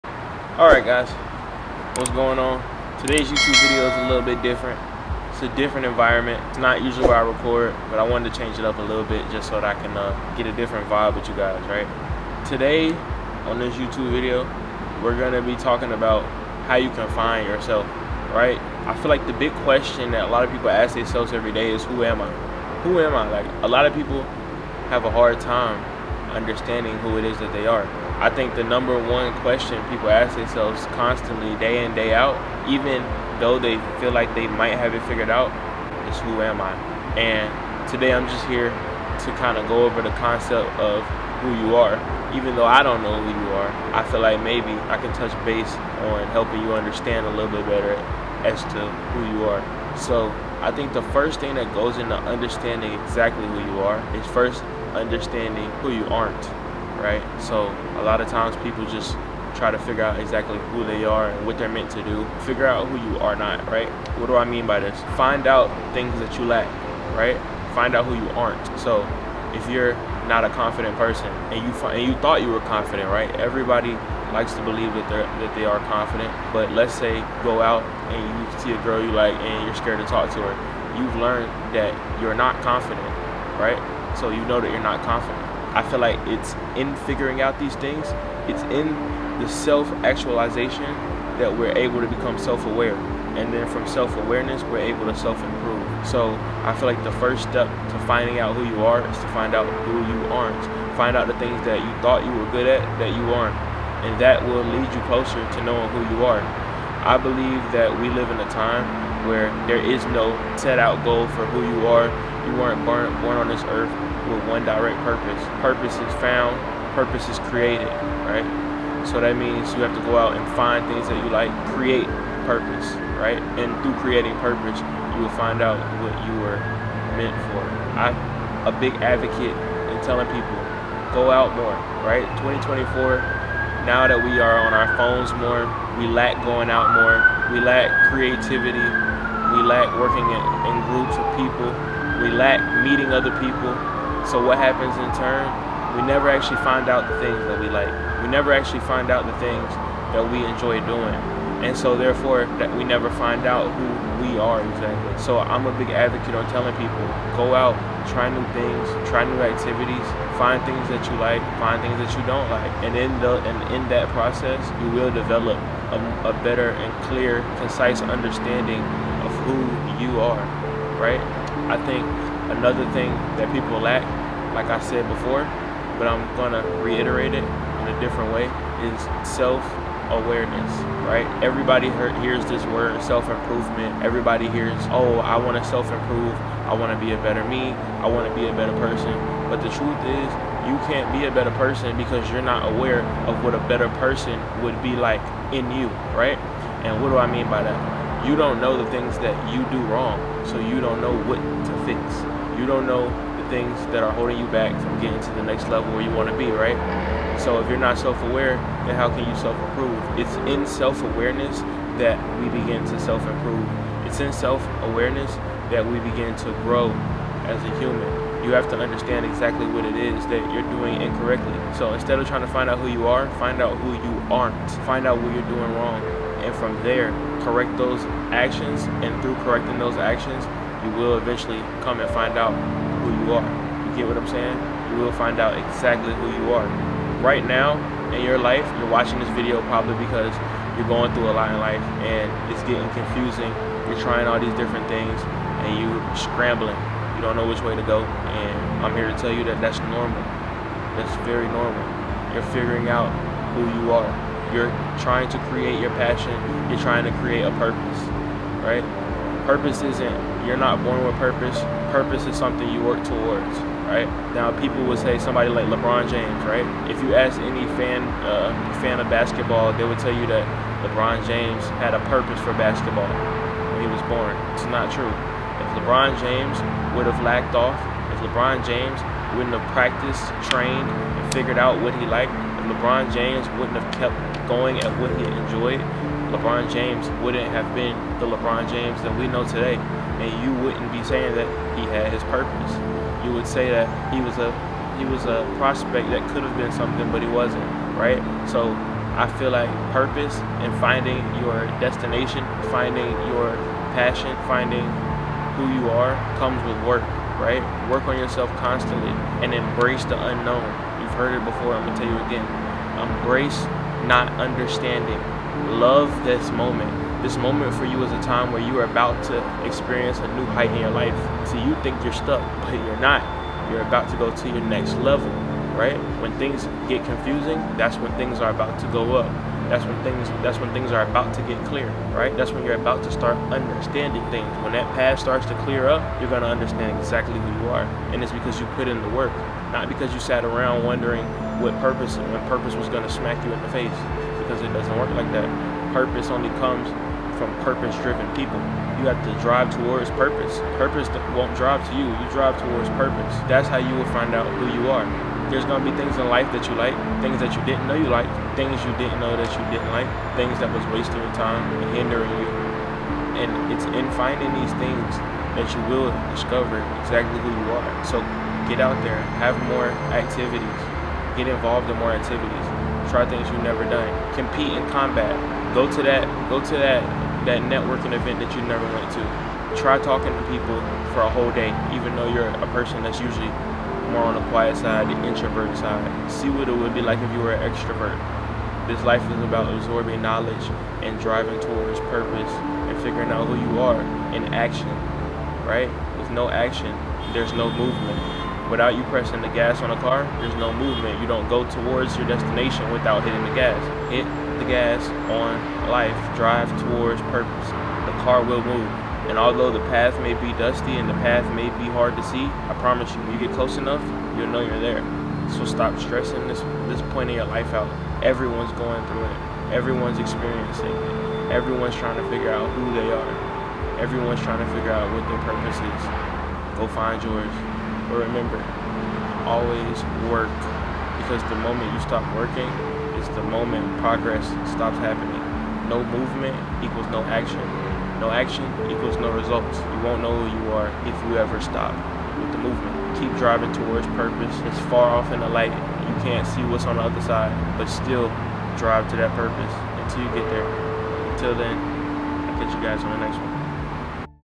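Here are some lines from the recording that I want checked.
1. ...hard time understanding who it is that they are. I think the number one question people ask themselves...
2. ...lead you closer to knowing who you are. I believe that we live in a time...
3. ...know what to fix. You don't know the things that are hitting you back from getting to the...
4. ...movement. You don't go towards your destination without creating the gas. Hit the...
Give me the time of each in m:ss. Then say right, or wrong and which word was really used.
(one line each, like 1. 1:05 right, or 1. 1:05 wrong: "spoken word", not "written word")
1. 0:25 right
2. 1:44 right
3. 3:21 wrong: "holding", not "hitting"
4. 6:40 wrong: "hitting", not "creating".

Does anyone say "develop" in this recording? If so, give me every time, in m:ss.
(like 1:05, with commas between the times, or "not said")
2:45.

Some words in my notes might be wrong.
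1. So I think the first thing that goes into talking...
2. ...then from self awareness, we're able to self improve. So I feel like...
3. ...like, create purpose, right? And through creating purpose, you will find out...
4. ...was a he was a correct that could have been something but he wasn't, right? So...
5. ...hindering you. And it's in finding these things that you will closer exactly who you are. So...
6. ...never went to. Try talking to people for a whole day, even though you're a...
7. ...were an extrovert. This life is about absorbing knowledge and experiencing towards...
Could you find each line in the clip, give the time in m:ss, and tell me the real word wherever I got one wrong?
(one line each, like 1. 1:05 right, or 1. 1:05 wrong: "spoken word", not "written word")
1. 0:49 wrong: "understanding", not "talking"
2. 1:33 right
3. 2:01 right
4. 4:54 wrong: "prospect", not "correct"
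5. 6:01 wrong: "discover", not "closer"
6. 6:18 right
7. 6:27 wrong: "driving", not "experiencing".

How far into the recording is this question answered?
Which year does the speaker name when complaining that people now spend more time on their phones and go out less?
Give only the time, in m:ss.
2:12.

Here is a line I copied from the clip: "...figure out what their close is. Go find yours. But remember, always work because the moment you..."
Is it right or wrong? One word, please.
wrong.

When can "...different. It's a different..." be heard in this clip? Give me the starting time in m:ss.
0:04.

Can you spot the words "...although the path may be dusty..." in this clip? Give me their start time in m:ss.
6:49.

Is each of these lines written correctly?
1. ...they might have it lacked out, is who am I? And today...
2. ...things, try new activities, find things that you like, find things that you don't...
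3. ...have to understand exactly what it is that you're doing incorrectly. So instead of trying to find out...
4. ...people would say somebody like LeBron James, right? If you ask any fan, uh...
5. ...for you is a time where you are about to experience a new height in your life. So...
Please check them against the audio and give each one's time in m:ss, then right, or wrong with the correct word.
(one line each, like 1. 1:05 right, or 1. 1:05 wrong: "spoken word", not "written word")
1. 0:34 wrong: "figured", not "lacked"
2. 2:38 right
3. 3:38 right
4. 4:24 right
5. 5:17 right.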